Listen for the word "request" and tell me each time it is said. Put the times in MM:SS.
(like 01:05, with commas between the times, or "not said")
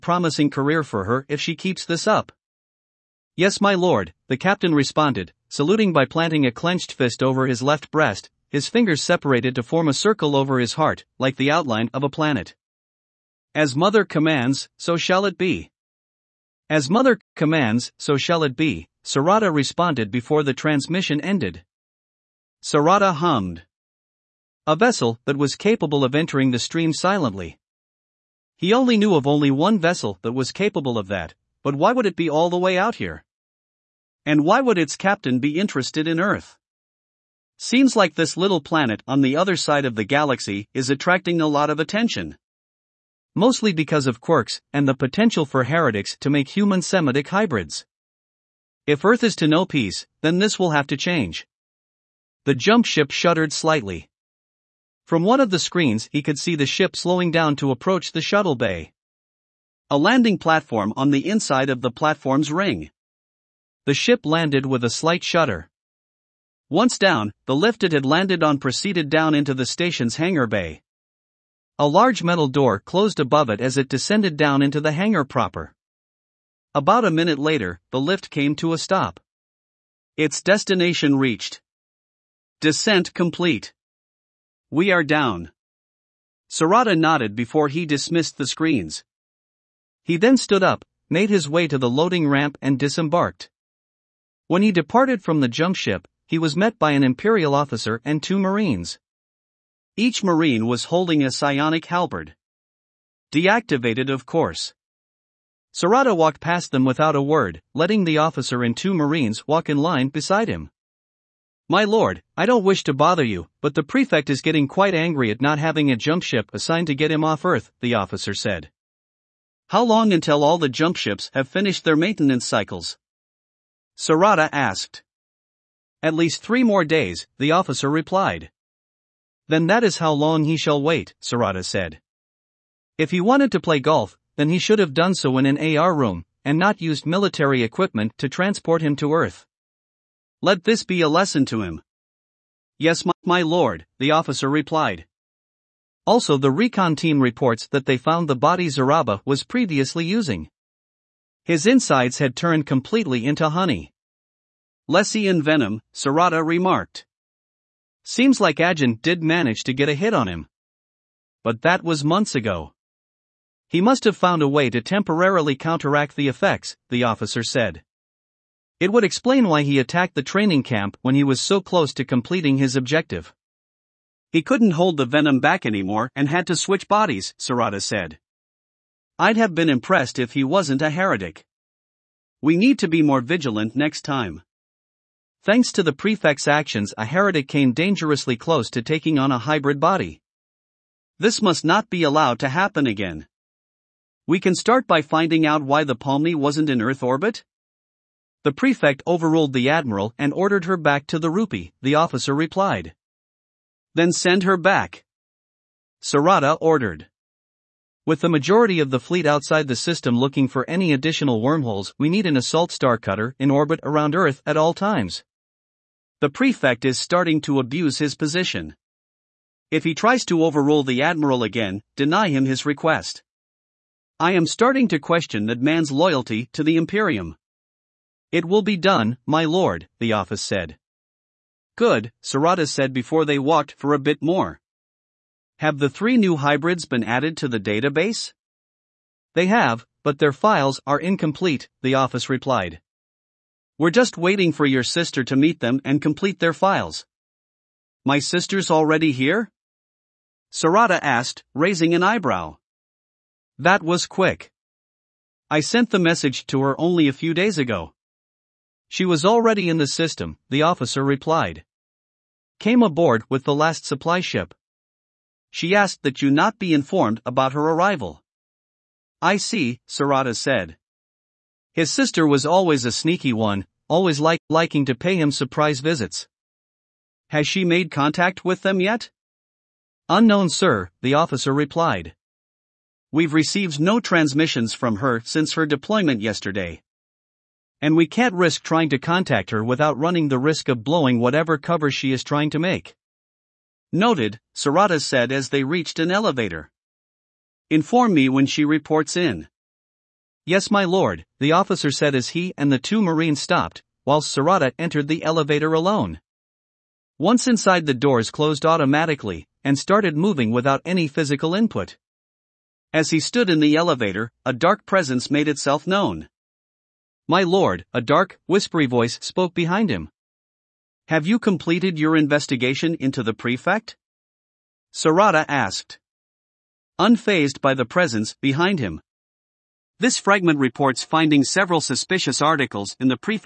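03:42.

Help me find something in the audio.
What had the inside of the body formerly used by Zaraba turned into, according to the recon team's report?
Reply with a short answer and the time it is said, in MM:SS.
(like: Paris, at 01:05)
honey, at 02:33.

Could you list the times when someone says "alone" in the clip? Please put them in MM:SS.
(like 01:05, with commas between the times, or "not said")
05:05.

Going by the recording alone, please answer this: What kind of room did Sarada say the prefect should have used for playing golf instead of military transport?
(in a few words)
AR room.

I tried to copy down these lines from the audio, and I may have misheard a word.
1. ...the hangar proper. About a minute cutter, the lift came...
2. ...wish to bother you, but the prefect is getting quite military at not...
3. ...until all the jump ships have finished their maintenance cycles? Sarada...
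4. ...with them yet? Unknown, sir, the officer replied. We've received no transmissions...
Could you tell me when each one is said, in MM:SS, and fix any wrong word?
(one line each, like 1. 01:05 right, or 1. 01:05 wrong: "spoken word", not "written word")
1. 01:14 wrong: "later", not "cutter"
2. 01:52 wrong: "angry", not "military"
3. 02:00 right
4. 04:38 right.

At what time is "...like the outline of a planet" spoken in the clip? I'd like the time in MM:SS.
00:11.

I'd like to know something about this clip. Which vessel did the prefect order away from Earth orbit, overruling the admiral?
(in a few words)
Palmy.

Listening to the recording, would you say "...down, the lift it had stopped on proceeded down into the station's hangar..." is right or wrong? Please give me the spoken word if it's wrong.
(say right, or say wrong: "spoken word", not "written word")
wrong: "landed", not "stopped".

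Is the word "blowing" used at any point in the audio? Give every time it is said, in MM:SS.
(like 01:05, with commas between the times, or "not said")
04:50.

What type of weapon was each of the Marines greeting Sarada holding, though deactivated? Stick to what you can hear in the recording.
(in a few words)
psionic halberd.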